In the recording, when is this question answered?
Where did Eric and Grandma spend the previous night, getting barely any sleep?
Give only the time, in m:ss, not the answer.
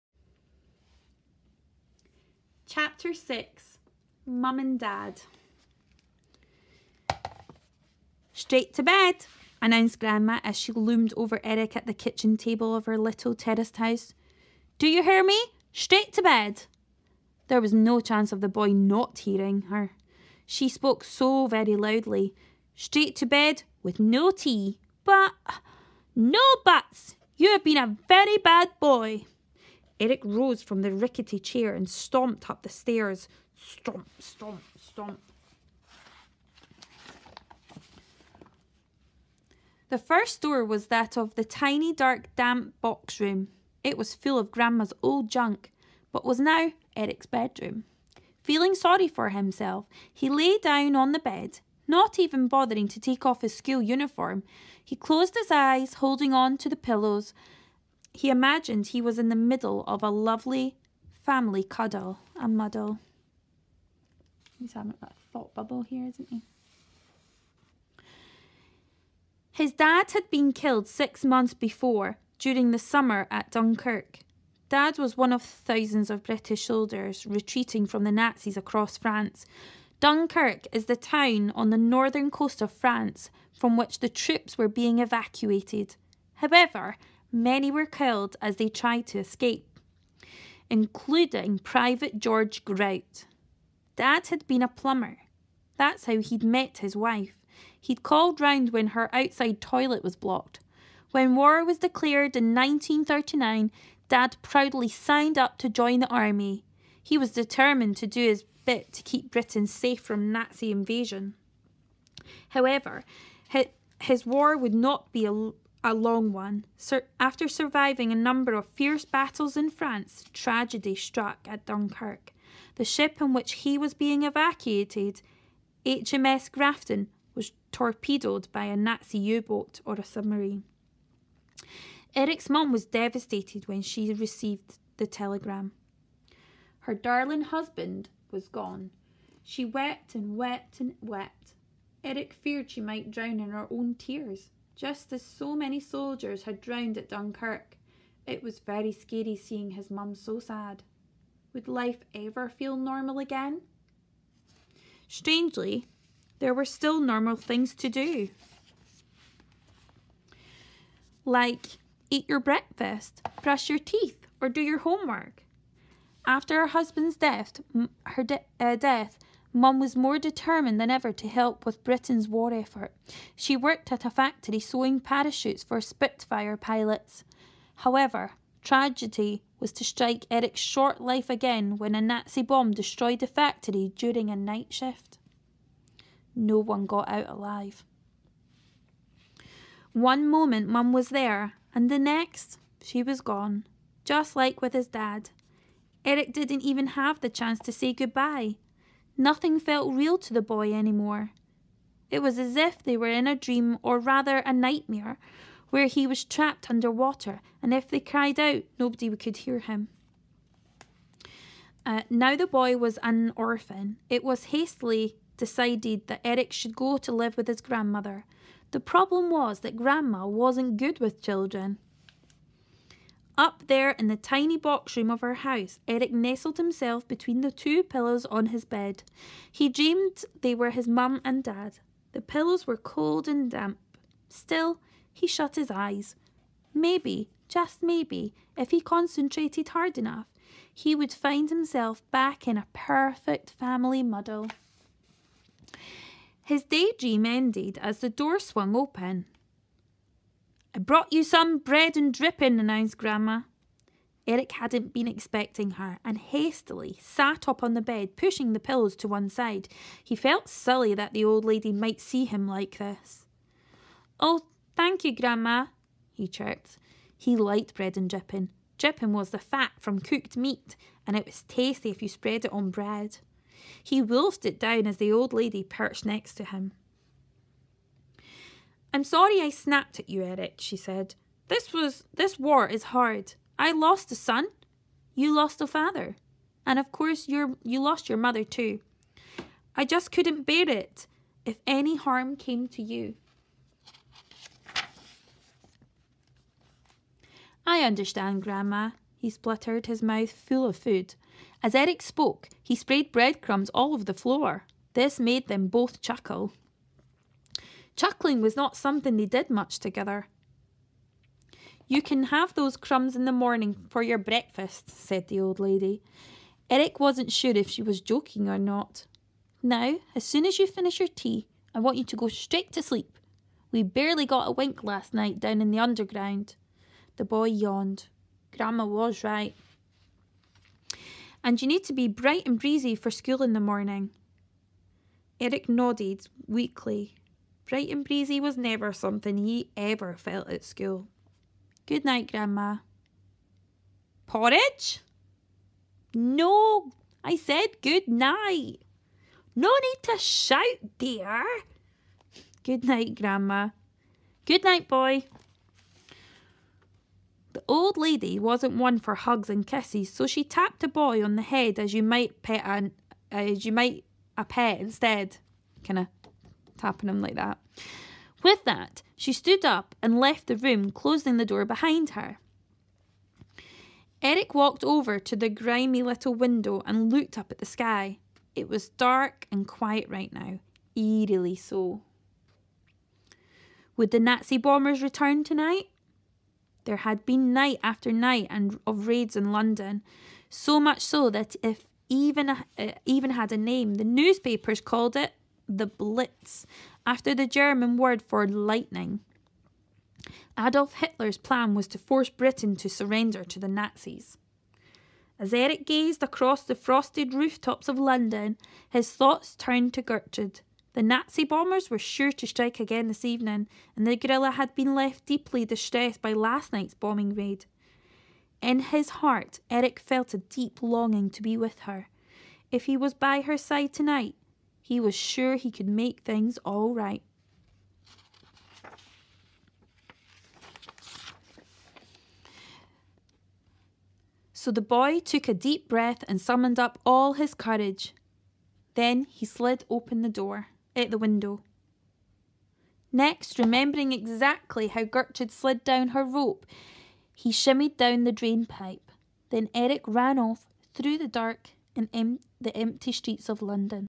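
5:25.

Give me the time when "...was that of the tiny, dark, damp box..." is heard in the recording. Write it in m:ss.
0:40.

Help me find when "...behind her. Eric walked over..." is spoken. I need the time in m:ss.
6:11.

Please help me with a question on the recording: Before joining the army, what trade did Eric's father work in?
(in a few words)
plumber.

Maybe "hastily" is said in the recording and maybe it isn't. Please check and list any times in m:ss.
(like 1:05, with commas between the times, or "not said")
3:34, 4:16.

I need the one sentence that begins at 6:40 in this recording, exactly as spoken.
Adolf Hitler's plan was to force Britain to surrender to the Nazis.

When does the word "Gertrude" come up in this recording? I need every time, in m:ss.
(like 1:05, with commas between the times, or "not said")
6:50, 7:25.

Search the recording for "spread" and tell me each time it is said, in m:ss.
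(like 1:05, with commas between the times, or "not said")
4:32.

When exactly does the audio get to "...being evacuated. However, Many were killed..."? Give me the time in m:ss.
1:24.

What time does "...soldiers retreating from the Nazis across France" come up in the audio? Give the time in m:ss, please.
1:16.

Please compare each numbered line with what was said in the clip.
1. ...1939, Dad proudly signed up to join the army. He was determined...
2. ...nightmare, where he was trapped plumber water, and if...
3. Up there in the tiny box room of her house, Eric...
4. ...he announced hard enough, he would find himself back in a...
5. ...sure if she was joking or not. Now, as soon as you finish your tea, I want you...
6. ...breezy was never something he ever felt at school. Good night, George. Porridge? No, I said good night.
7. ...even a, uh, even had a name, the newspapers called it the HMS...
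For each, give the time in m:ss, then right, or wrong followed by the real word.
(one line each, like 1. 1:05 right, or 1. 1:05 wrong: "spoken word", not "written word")
1. 1:42 right
2. 3:24 wrong: "under", not "plumber"
3. 3:43 right
4. 3:58 wrong: "concentrated", not "announced"
5. 5:17 right
6. 5:38 wrong: "Grandma", not "George"
7. 6:32 wrong: "Blitz", not "HMS".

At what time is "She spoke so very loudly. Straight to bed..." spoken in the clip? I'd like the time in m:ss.
0:20.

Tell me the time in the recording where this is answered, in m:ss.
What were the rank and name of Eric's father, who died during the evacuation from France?
1:31.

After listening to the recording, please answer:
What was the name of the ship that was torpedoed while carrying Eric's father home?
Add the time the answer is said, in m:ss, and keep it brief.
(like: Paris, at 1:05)
HMS Grafton, at 2:05.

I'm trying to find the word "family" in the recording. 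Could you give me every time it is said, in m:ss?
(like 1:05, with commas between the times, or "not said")
1:01, 4:03.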